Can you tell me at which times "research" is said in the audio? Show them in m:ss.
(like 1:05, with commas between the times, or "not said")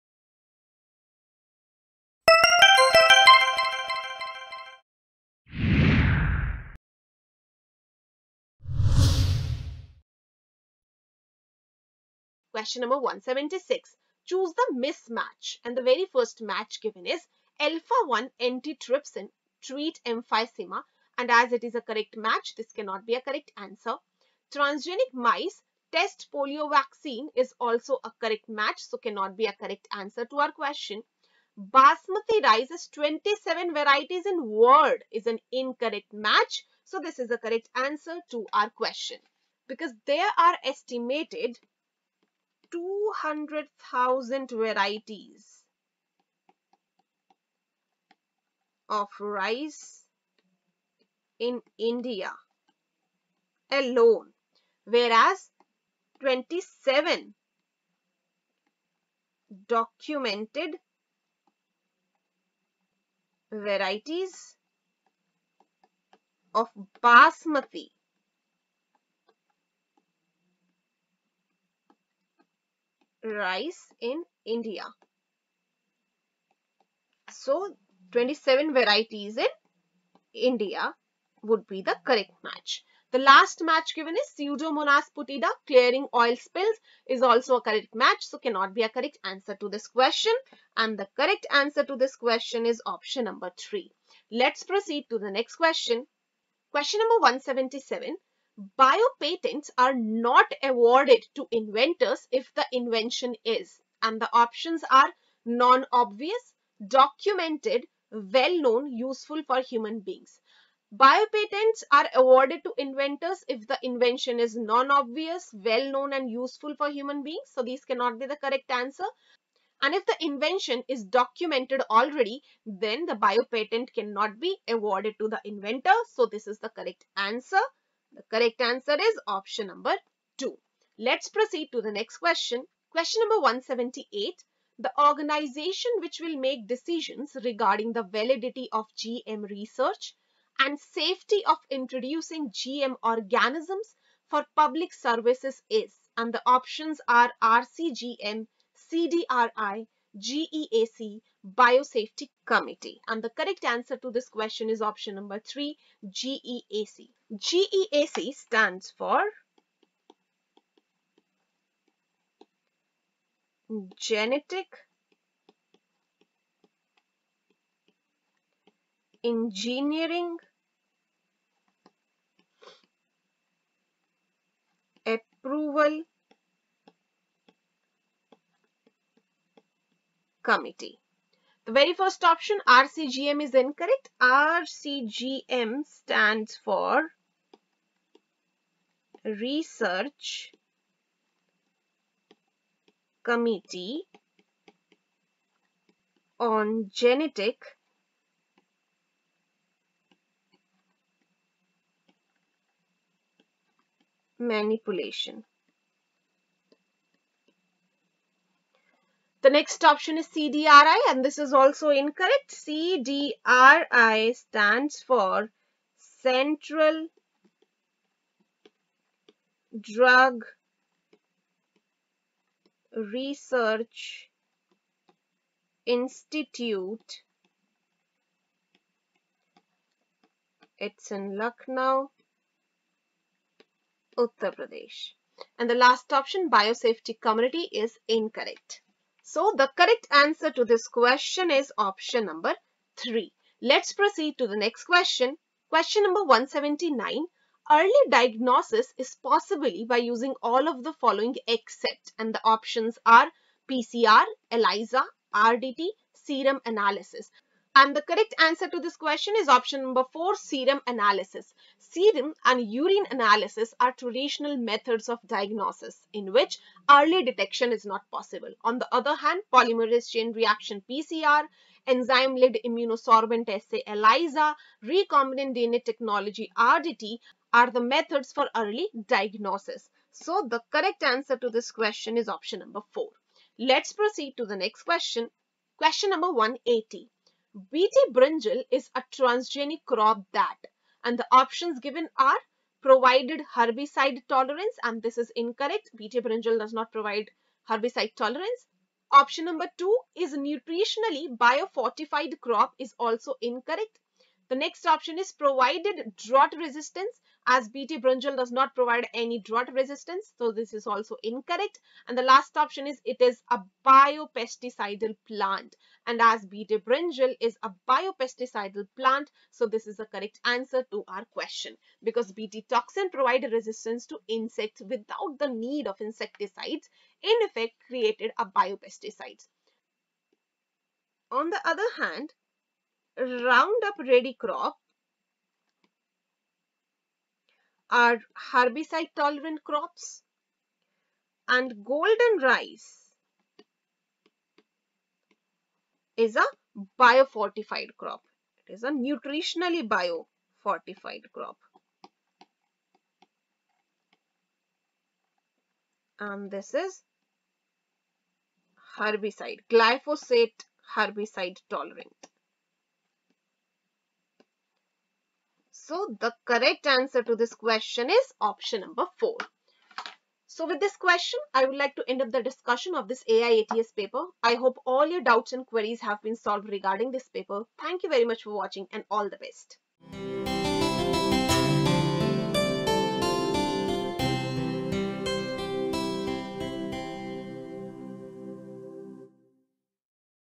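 2:19, 3:09, 3:42.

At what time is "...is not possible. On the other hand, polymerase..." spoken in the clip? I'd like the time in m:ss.
4:27.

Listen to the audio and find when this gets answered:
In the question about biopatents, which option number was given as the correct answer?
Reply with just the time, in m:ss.
2:09.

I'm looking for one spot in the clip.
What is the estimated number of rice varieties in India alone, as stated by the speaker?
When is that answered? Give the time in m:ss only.
0:42.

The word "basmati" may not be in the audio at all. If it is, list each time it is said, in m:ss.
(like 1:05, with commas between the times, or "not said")
0:31, 1:07.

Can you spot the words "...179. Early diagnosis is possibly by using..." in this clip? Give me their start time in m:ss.
4:06.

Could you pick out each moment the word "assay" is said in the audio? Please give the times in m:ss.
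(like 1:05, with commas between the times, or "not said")
4:33.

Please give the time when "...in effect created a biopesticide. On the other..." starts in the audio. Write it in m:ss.
5:27.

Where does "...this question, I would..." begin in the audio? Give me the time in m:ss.
6:10.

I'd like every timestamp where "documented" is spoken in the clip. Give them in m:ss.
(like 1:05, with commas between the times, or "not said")
0:59, 1:46, 2:01.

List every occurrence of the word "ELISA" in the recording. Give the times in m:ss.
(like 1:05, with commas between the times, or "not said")
4:14, 4:33.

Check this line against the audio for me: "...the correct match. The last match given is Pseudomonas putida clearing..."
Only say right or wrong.
right.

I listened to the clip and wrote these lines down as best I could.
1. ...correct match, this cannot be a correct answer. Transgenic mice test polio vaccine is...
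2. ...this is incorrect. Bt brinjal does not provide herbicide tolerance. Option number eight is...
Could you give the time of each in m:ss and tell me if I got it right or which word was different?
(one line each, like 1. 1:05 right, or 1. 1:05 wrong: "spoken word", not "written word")
1. 0:21 right
2. 4:55 wrong: "two", not "eight".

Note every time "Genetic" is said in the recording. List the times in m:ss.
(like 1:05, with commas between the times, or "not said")
2:43, 3:16.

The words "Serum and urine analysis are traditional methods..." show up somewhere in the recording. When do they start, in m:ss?
4:21.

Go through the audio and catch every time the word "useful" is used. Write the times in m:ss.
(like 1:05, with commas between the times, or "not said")
1:48, 1:56.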